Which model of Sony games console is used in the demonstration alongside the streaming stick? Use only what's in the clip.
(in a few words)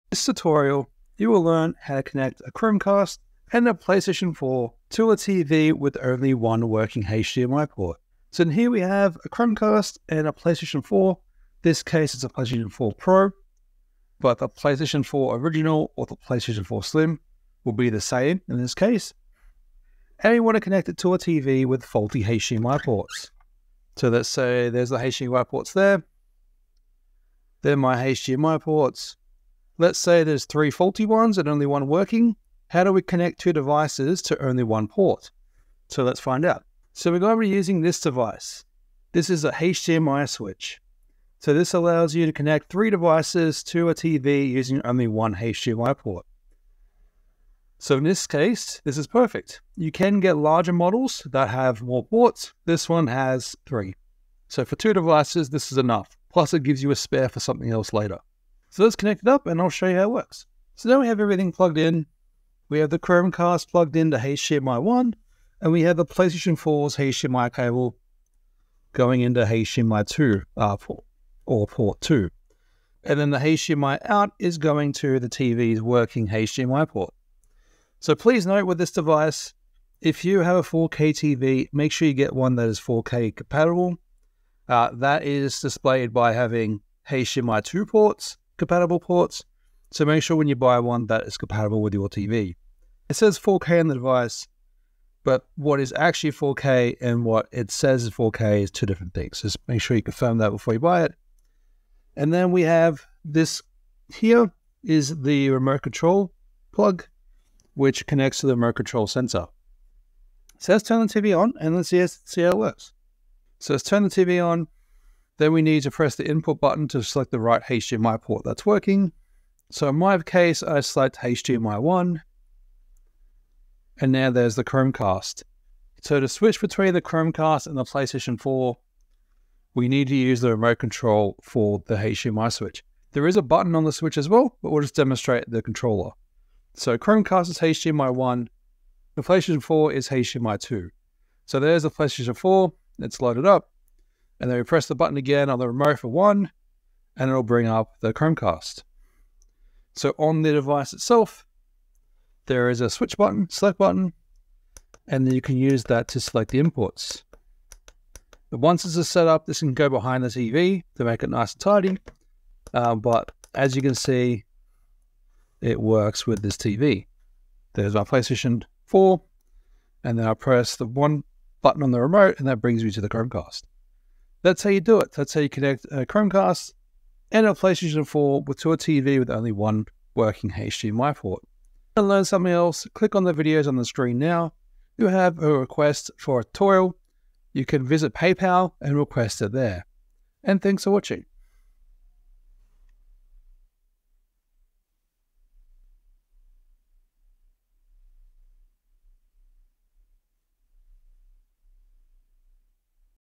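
PlayStation 4 Pro.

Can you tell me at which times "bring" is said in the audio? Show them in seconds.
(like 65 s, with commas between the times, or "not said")
147 s, 172 s.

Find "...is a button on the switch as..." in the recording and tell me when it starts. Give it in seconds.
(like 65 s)
133 s.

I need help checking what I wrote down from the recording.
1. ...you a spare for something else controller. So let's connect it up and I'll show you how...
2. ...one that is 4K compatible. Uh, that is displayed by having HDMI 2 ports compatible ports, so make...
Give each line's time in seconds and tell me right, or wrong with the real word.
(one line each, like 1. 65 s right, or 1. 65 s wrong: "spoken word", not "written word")
1. 56 s wrong: "later", not "controller"
2. 82 s right.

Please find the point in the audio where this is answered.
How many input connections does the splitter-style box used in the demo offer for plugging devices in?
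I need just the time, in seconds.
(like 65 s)
52 s.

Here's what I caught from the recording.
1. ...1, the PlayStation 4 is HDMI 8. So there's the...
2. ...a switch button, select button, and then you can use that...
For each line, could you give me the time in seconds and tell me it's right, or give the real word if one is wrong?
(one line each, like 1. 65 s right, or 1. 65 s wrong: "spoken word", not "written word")
1. 138 s wrong: "2", not "8"
2. 152 s right.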